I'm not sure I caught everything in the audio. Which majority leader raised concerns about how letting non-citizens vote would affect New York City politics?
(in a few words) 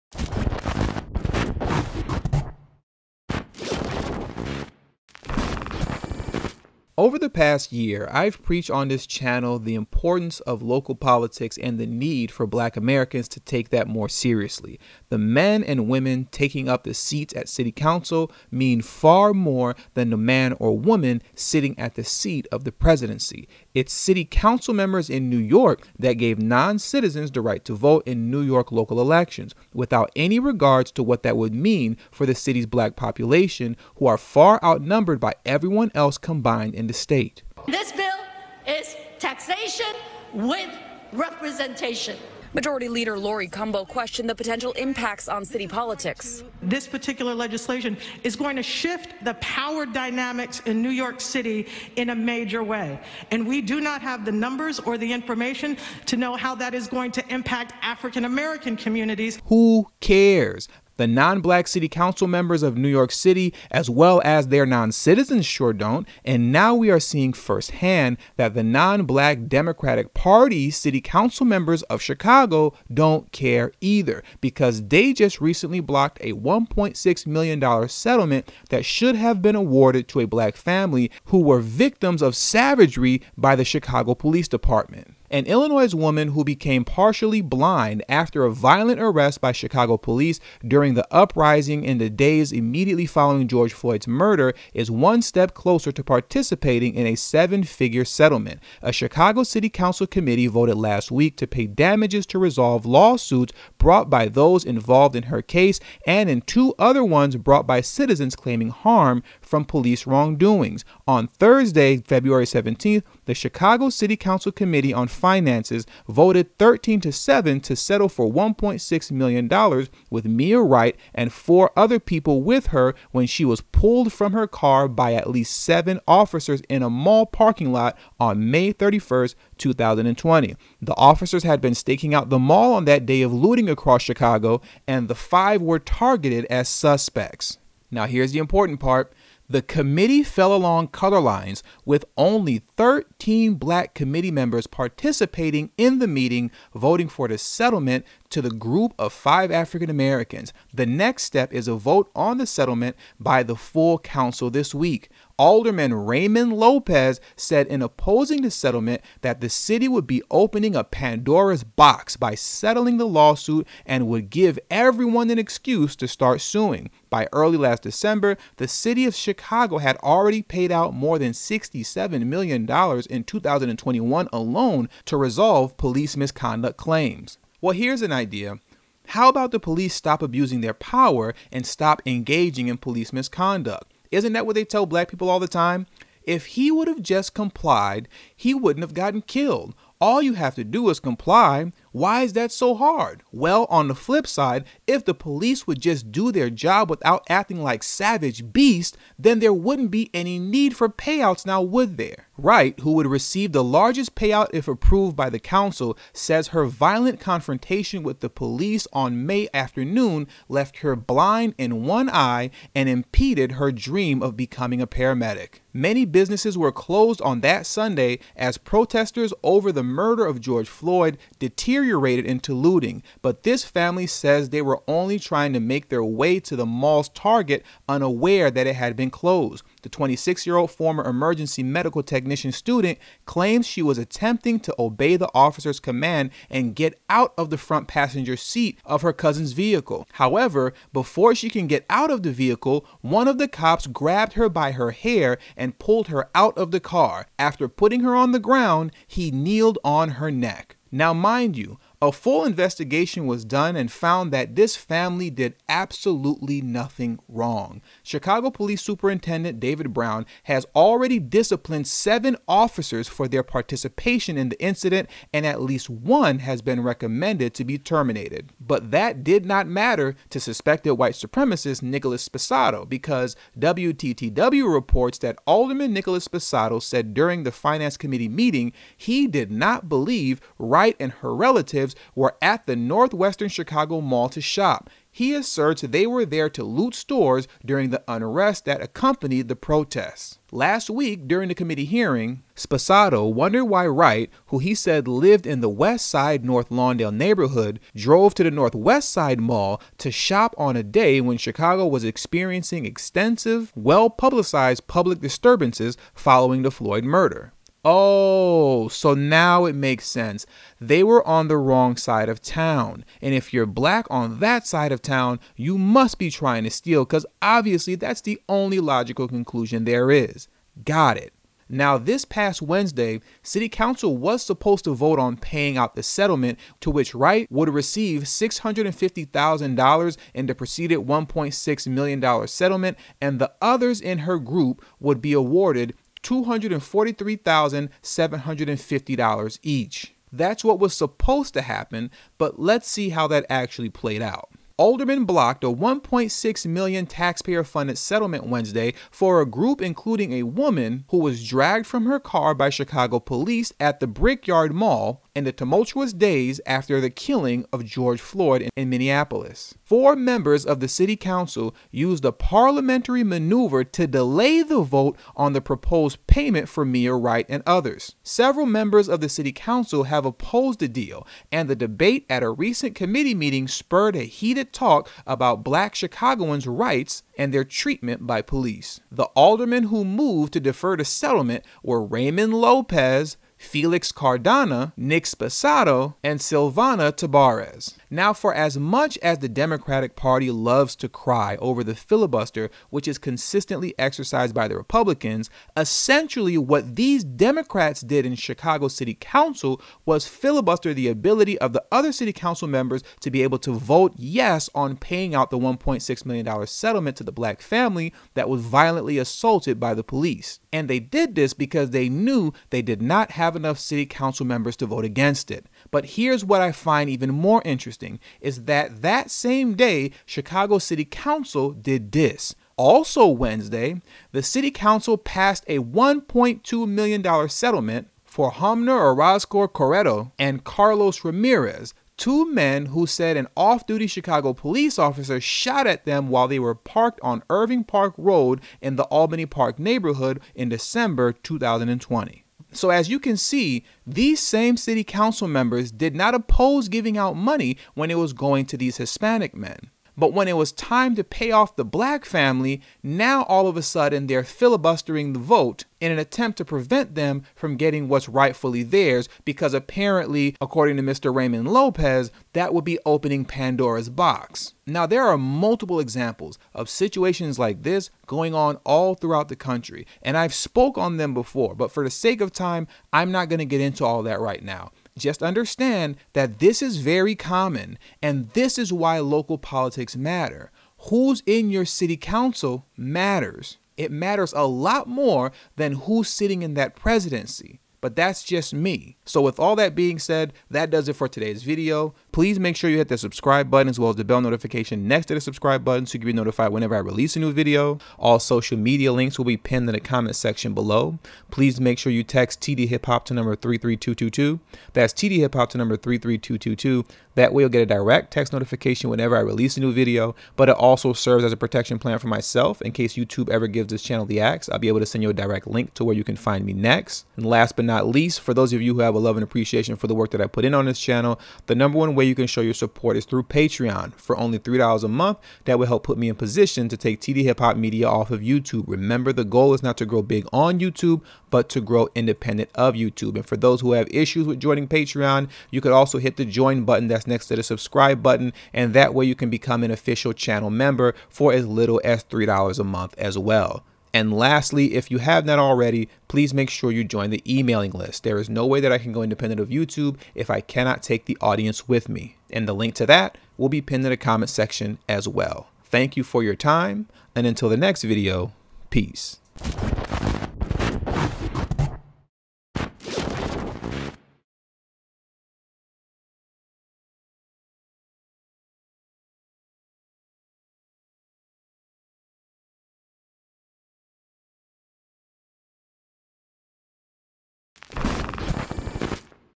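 Laurie Cumbo.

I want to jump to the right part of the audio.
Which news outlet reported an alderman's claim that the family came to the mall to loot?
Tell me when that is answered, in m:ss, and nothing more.
4:33.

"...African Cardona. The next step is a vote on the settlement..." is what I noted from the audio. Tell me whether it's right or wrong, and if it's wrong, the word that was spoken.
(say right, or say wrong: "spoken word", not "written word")
wrong: "Americans", not "Cardona".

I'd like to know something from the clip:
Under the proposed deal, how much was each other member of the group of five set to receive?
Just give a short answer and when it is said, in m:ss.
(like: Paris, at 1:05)
$243,750, at 5:36.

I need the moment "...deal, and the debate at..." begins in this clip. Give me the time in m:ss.
6:10.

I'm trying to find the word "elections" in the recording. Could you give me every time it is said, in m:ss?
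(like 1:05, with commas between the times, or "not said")
0:28.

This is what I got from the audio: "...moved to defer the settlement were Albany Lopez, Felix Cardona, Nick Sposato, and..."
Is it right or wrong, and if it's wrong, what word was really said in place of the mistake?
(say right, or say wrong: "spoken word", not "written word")
wrong: "Raymond", not "Albany".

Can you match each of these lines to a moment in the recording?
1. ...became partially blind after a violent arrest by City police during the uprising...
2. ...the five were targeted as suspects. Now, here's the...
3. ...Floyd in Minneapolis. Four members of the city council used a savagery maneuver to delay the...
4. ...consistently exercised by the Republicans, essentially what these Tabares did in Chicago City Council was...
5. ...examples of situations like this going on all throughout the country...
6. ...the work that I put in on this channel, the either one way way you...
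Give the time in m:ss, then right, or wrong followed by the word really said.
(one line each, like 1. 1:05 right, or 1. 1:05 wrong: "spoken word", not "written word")
1. 1:26 wrong: "Chicago", not "City"
2. 2:15 right
3. 5:58 wrong: "parliamentary", not "savagery"
4. 6:33 wrong: "Democrats", not "Tabares"
5. 7:45 right
6. 8:40 wrong: "number", not "either".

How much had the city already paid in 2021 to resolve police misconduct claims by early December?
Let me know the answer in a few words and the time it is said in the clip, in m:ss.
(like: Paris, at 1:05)
$67 million, at 2:51.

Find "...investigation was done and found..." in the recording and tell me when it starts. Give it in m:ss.
4:12.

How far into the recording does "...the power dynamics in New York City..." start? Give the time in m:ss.
0:49.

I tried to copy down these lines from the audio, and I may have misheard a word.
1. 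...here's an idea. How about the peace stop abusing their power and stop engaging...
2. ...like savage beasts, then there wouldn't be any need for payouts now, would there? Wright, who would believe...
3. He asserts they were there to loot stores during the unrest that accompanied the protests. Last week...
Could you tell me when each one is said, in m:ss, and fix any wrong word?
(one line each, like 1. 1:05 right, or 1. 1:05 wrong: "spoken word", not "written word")
1. 2:57 wrong: "police", not "peace"
2. 3:17 wrong: "receive", not "believe"
3. 4:45 right.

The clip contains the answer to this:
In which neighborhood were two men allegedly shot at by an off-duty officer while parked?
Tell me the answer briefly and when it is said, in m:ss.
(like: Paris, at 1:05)
Albany Park, at 7:19.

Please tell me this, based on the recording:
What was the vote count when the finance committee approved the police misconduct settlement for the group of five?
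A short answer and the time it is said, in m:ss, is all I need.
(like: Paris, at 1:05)
13 to 7, at 1:56.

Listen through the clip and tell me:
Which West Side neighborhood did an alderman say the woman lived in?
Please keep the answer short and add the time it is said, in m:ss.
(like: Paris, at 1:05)
North Lawndale, at 4:56.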